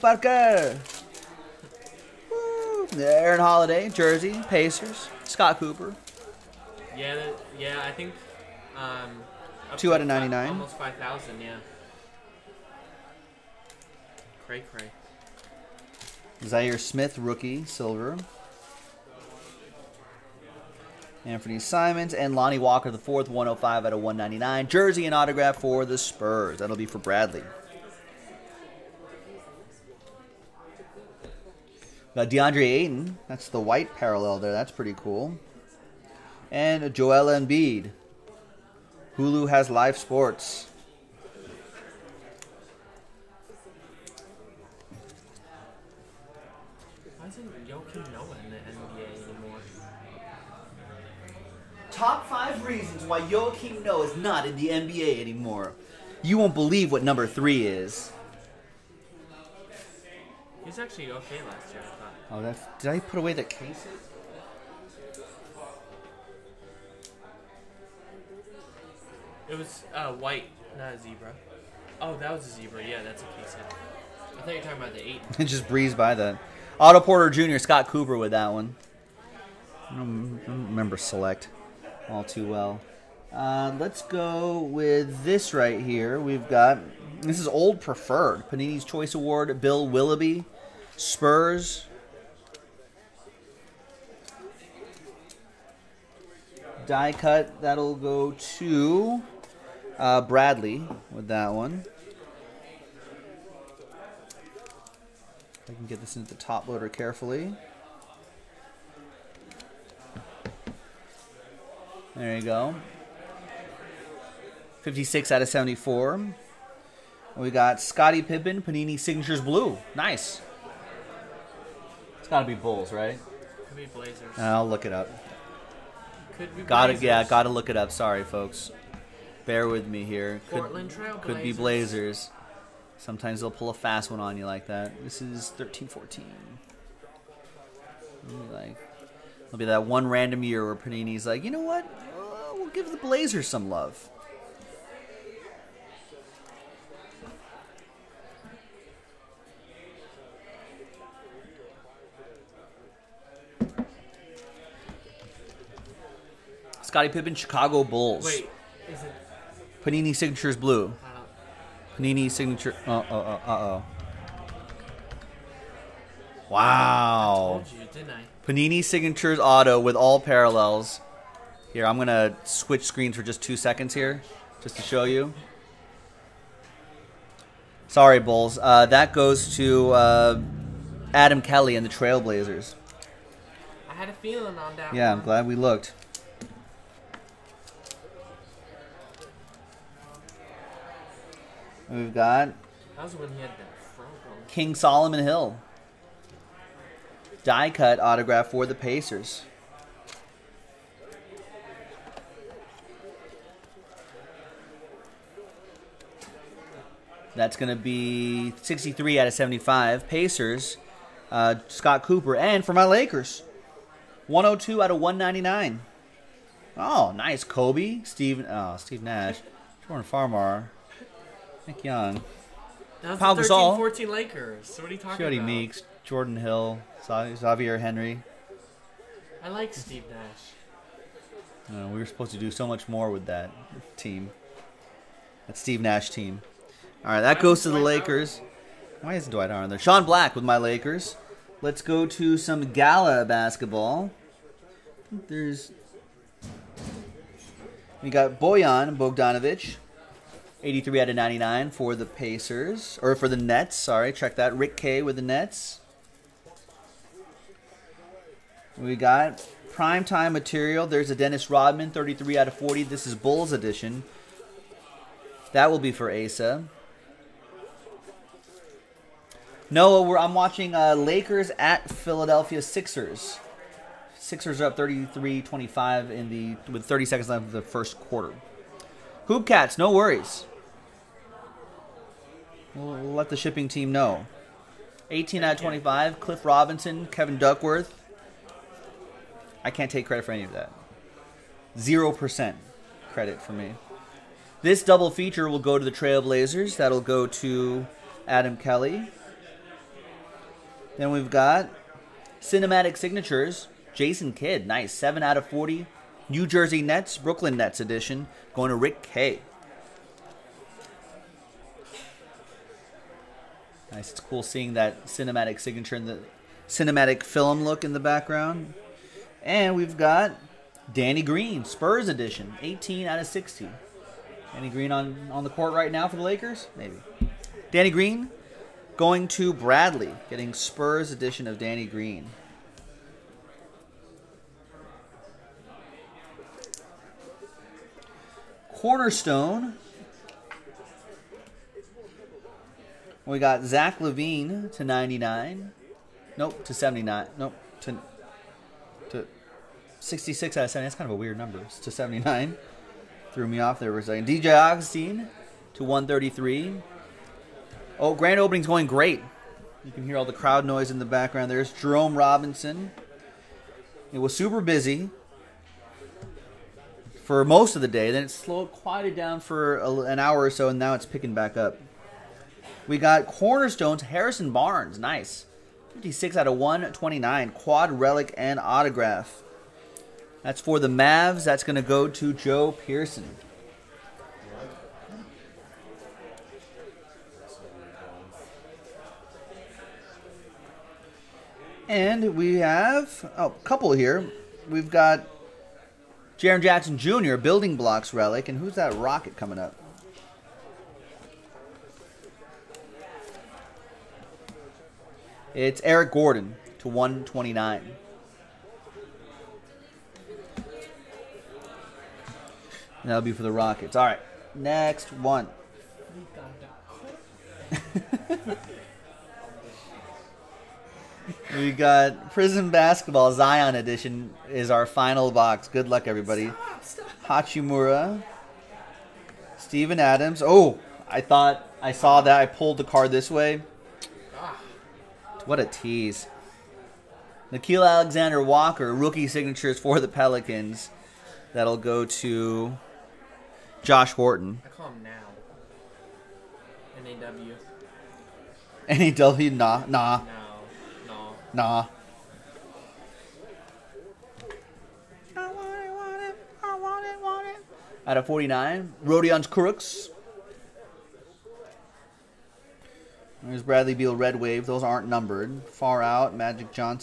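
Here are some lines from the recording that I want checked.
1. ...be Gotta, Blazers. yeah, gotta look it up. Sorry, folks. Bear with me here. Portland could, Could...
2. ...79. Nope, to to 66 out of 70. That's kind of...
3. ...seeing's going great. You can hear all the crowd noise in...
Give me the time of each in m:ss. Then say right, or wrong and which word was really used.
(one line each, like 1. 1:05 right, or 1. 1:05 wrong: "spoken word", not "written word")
1. 2:06 right
2. 5:46 right
3. 5:58 wrong: "opening", not "seeing".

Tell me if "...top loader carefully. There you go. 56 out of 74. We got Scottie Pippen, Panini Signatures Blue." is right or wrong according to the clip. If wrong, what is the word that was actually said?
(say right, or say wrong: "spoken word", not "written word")
right.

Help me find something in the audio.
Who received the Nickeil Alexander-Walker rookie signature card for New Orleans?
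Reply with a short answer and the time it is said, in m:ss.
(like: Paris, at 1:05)
Josh Horton, at 7:23.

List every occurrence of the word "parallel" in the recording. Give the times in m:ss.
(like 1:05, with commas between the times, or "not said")
0:33, 2:50.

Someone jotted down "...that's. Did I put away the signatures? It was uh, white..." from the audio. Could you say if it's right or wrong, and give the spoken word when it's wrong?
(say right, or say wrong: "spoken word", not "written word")
wrong: "cases", not "signatures".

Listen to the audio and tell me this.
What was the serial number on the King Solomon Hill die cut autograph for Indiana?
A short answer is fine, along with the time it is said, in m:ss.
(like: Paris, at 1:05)
63 out of 75, at 3:28.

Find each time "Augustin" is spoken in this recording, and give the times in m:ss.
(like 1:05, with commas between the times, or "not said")
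5:54.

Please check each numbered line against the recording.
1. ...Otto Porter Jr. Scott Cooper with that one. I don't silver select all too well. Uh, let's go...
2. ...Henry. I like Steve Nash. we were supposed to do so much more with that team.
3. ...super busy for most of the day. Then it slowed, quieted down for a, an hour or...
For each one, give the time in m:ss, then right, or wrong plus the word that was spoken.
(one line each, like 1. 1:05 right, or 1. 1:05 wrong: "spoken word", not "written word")
1. 1:16 wrong: "remember", not "silver"
2. 3:47 right
3. 6:04 right.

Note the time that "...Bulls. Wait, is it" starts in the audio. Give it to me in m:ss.
2:37.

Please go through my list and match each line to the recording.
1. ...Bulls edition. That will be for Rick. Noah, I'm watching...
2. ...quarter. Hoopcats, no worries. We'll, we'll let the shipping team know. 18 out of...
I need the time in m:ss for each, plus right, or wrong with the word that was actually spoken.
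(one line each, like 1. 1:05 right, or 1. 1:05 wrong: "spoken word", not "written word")
1. 4:23 wrong: "Asa", not "Rick"
2. 4:37 right.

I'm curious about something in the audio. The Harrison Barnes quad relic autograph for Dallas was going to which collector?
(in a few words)
Joe Pearson.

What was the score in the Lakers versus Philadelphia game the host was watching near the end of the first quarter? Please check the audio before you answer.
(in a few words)
33-25.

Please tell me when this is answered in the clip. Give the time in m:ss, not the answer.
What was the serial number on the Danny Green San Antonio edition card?
5:22.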